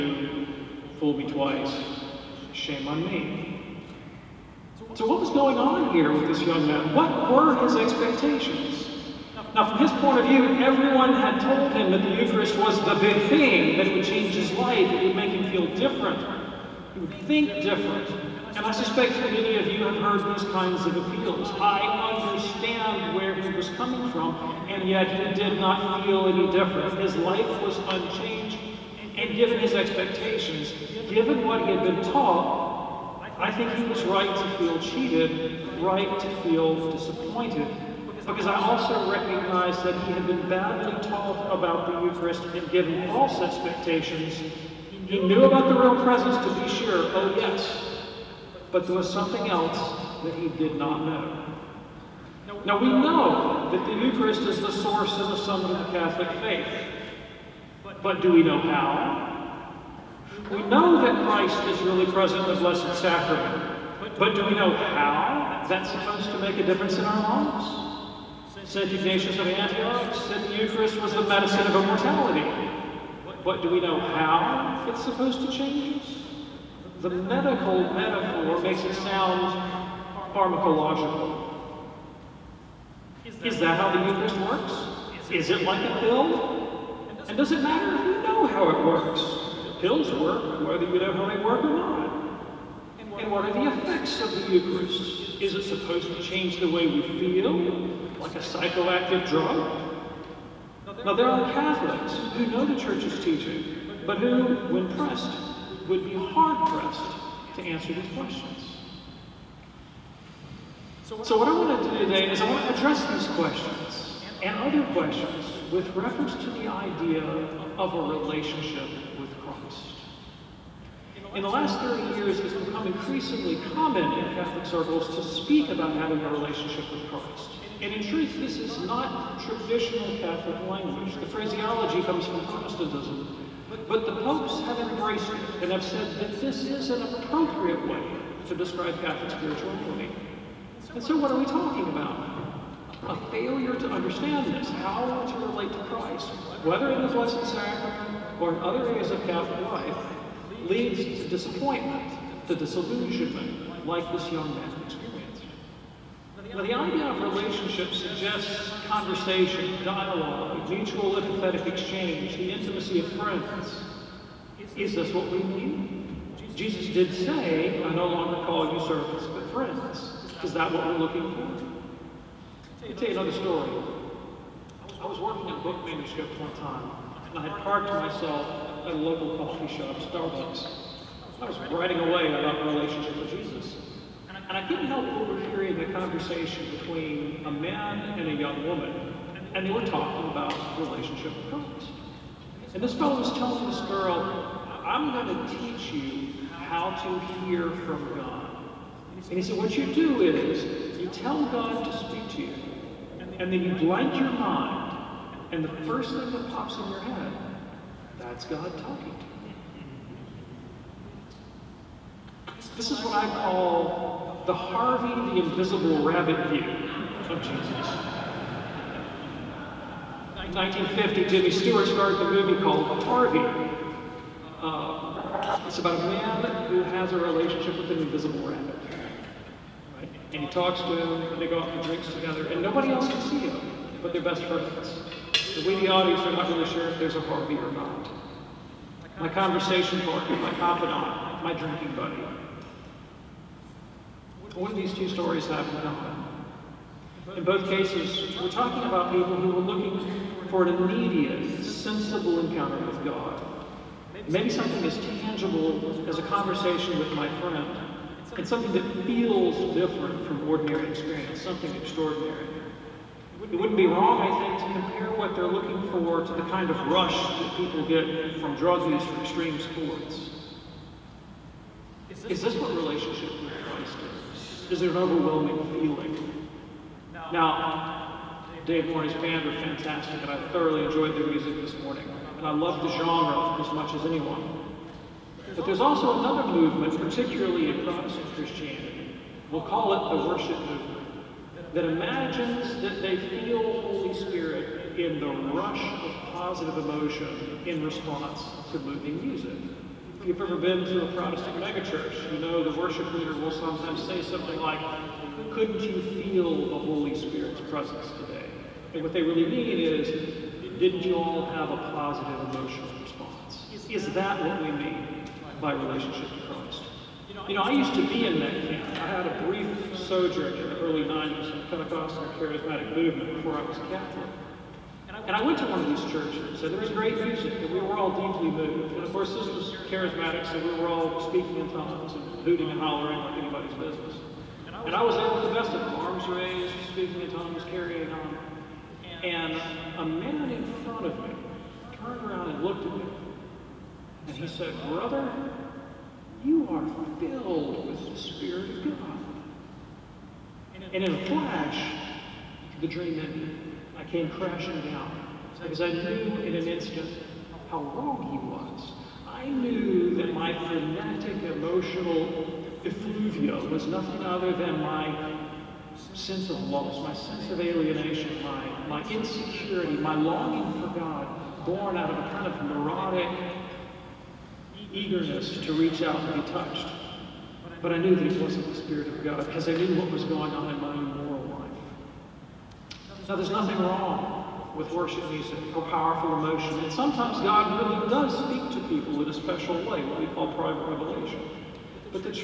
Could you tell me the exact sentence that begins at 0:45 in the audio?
He knew about the real presence, to be sure, oh yes, but there was something else that he did not know.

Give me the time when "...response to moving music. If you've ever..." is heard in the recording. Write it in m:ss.
4:57.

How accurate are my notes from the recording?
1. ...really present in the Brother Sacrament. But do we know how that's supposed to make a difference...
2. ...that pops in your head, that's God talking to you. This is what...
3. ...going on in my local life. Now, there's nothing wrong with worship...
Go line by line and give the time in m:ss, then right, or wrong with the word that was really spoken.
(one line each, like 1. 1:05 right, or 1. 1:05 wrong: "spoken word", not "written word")
1. 1:01 wrong: "Blessed", not "Brother"
2. 3:26 right
3. 6:20 wrong: "moral", not "local".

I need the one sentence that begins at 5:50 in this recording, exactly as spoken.
And in a flash, the dream ended.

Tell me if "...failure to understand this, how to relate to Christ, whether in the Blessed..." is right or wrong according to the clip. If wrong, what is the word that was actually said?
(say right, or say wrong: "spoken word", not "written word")
right.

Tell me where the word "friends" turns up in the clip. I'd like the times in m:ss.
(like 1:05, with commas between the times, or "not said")
2:43, 2:49, 3:54, 4:17.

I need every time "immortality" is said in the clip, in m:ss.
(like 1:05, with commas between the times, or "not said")
1:11.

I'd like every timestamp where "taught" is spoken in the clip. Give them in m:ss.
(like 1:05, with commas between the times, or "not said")
0:32, 0:41.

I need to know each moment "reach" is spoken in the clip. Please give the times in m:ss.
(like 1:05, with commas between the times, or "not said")
6:15.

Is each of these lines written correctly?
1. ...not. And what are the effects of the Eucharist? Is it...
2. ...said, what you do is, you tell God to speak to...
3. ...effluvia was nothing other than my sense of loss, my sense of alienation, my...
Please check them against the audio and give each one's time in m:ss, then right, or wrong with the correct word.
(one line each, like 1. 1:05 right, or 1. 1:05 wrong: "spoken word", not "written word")
1. 1:31 right
2. 3:19 right
3. 6:02 right.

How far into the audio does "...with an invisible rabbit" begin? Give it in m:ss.
3:47.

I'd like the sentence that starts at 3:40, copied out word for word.
1950, Jimmy Stewart started the movie called Harvey.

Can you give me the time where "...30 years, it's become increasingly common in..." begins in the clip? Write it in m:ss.
2:01.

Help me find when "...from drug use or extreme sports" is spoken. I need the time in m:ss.
4:28.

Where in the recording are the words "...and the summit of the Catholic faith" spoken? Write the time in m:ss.
0:55.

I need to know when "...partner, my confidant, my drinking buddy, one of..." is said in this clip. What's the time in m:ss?
4:00.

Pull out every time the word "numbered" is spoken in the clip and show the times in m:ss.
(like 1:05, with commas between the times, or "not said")
not said.